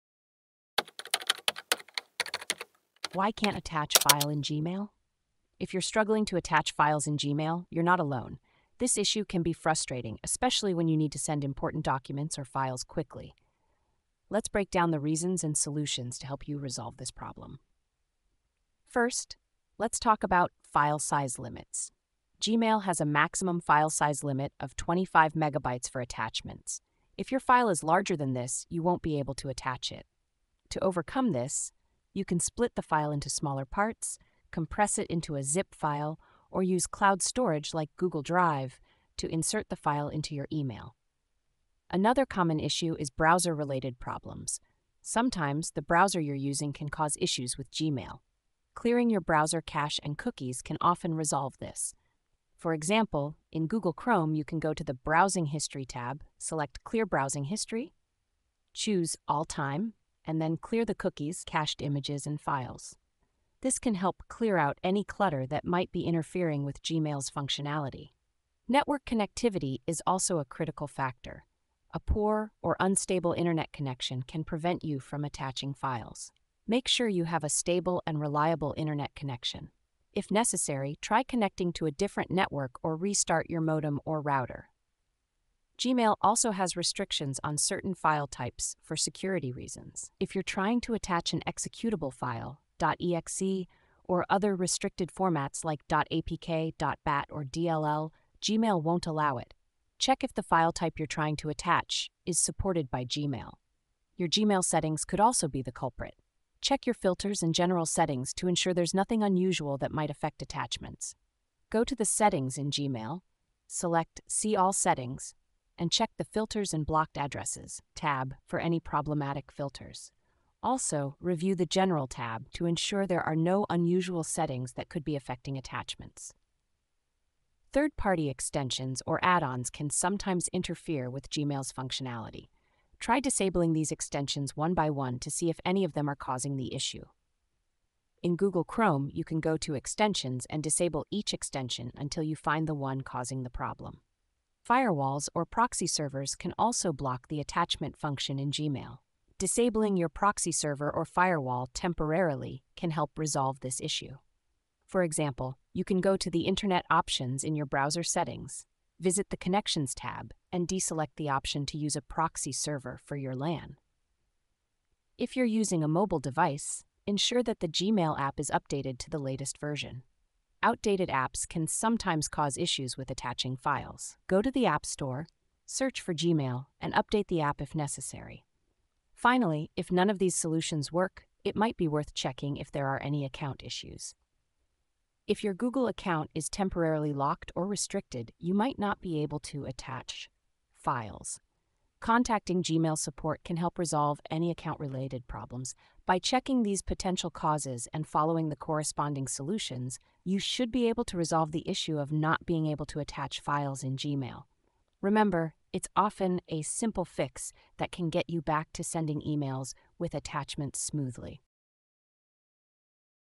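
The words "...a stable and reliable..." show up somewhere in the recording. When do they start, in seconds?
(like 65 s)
77 s.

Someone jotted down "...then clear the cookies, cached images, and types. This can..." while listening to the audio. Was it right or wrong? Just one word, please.
wrong.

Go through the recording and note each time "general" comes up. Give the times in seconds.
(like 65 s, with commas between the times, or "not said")
107 s, 121 s.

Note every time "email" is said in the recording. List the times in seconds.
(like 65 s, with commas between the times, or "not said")
40 s, 209 s.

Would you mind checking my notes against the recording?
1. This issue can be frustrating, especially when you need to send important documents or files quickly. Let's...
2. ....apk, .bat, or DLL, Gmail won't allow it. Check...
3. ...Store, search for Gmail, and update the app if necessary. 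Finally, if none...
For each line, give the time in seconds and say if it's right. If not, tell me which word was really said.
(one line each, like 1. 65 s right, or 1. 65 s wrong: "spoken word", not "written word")
1. 8 s right
2. 95 s right
3. 174 s right.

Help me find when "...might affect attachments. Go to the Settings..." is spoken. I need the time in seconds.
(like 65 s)
109 s.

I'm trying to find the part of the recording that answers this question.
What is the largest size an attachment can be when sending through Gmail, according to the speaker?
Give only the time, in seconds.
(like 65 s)
24 s.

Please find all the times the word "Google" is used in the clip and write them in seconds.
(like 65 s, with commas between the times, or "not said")
37 s, 53 s, 138 s, 185 s.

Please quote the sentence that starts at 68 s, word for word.
Network connectivity is also a critical factor.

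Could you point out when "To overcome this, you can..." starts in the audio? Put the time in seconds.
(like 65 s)
30 s.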